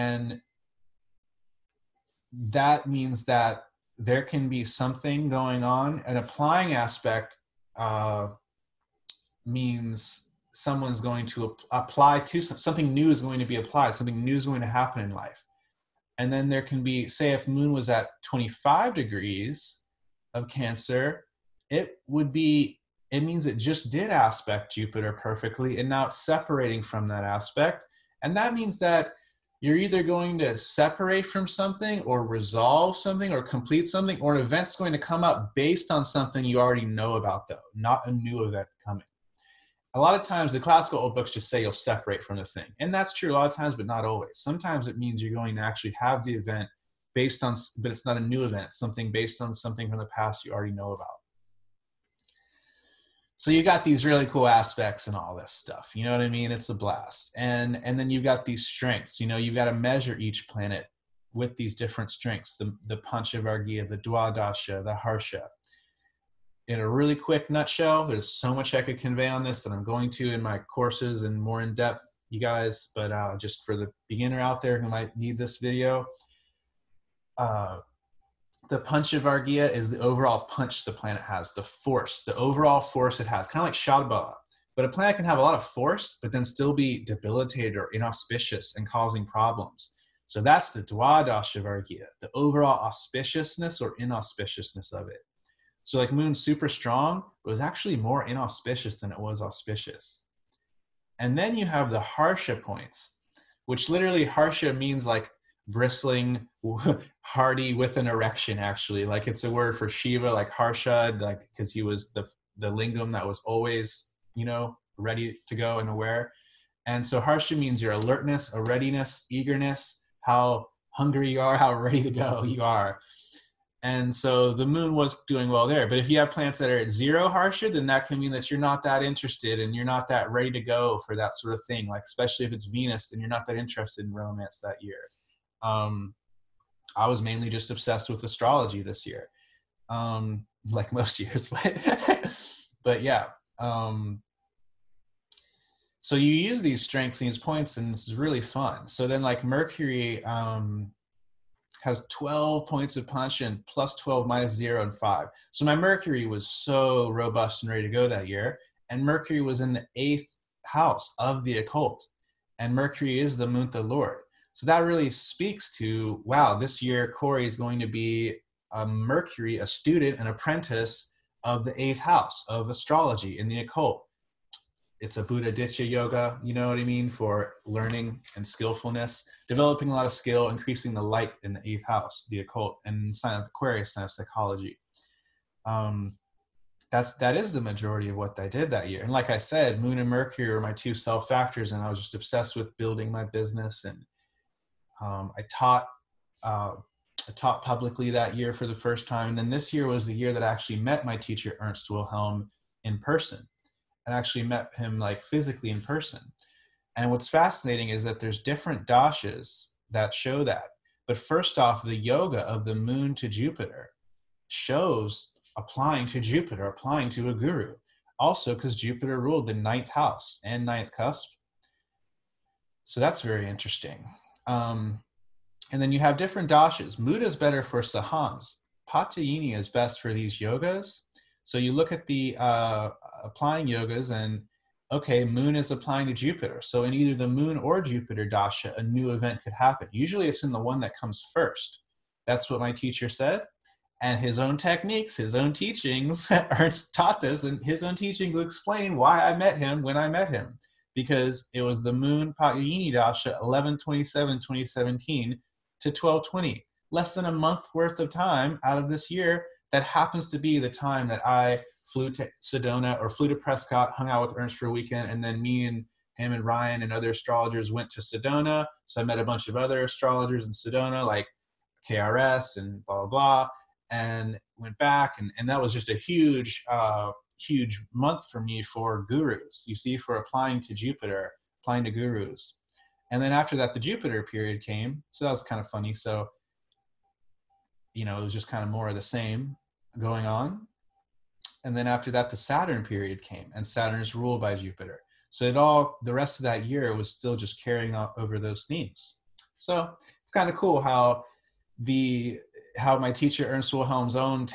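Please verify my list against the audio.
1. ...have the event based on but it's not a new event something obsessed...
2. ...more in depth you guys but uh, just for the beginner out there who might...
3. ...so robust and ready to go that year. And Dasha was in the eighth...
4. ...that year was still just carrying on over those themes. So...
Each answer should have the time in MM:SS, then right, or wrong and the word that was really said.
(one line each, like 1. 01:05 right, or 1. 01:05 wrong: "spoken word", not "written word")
1. 00:45 wrong: "based", not "obsessed"
2. 01:11 right
3. 02:36 wrong: "Mercury", not "Dasha"
4. 04:56 right.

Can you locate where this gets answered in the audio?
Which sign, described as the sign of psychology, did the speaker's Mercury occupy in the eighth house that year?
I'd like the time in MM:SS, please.
03:03.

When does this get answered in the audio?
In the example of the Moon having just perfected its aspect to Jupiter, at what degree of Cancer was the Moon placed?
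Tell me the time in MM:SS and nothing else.
00:18.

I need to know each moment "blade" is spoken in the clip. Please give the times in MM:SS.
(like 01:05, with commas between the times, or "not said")
not said.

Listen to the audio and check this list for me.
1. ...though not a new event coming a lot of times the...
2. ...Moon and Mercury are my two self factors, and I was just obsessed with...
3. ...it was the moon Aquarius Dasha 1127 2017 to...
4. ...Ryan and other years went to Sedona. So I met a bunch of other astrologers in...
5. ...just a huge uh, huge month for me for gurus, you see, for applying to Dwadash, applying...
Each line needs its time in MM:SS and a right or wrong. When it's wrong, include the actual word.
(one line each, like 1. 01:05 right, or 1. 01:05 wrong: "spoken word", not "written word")
1. 00:37 right
2. 03:09 right
3. 04:11 wrong: "Pagini", not "Aquarius"
4. 04:26 wrong: "astrologers", not "years"
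5. 04:35 wrong: "Jupiter", not "Dwadash".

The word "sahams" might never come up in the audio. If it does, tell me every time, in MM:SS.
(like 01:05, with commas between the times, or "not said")
03:47.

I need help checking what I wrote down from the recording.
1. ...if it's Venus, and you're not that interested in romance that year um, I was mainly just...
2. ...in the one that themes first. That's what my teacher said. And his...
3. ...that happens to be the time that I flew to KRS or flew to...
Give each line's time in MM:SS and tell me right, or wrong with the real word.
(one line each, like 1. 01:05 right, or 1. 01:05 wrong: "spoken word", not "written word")
1. 02:12 right
2. 04:00 wrong: "comes", not "themes"
3. 04:19 wrong: "Sedona", not "KRS".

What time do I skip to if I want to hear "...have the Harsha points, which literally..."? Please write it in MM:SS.
01:41.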